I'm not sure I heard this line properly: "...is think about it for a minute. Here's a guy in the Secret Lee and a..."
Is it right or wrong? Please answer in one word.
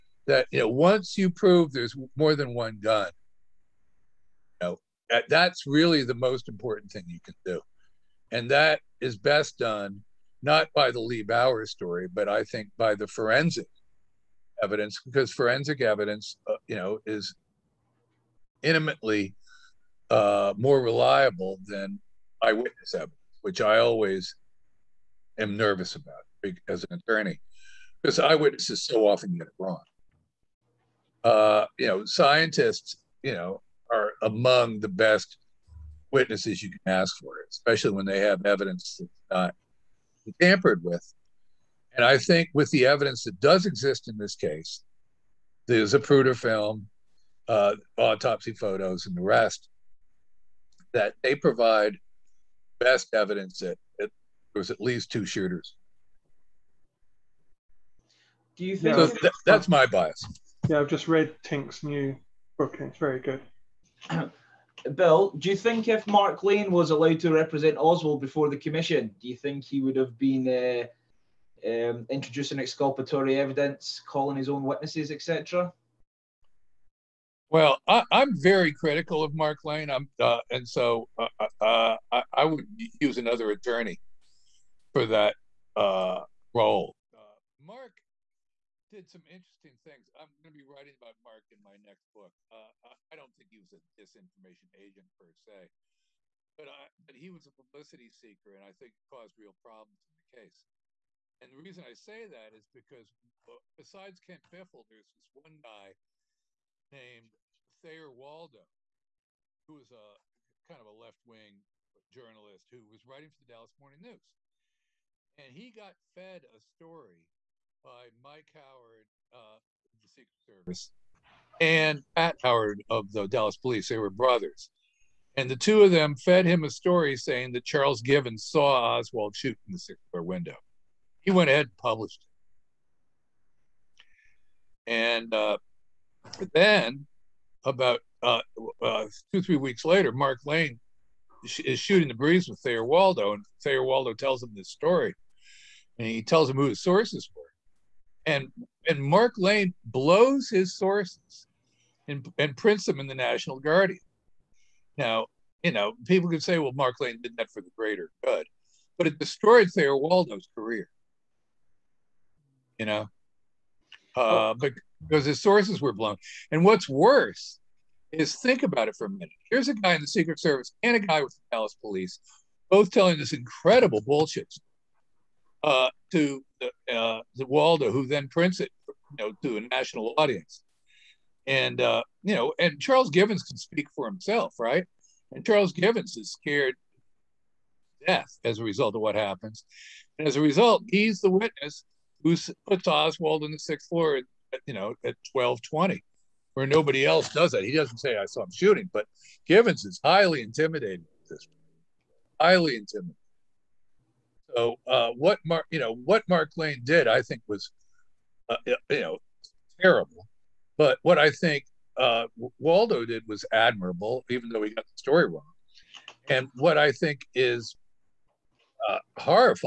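wrong.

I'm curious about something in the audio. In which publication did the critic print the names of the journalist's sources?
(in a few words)
National Guardian.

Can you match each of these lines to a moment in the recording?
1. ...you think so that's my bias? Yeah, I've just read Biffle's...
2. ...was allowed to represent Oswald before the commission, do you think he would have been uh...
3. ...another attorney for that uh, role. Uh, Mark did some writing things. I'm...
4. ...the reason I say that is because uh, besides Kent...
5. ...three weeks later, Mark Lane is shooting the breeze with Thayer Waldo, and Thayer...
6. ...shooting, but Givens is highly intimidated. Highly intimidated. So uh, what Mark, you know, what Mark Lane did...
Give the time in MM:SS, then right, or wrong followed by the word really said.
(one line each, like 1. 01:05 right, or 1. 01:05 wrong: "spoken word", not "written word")
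1. 00:58 wrong: "Tink", not "Biffle"
2. 01:06 right
3. 01:23 wrong: "interesting", not "writing"
4. 01:41 right
5. 02:19 right
6. 03:18 right.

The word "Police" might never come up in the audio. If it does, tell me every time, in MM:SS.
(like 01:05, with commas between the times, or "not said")
02:03, 02:51.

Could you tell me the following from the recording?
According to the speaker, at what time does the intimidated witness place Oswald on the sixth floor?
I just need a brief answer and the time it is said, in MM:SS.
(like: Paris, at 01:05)
12:20, at 03:15.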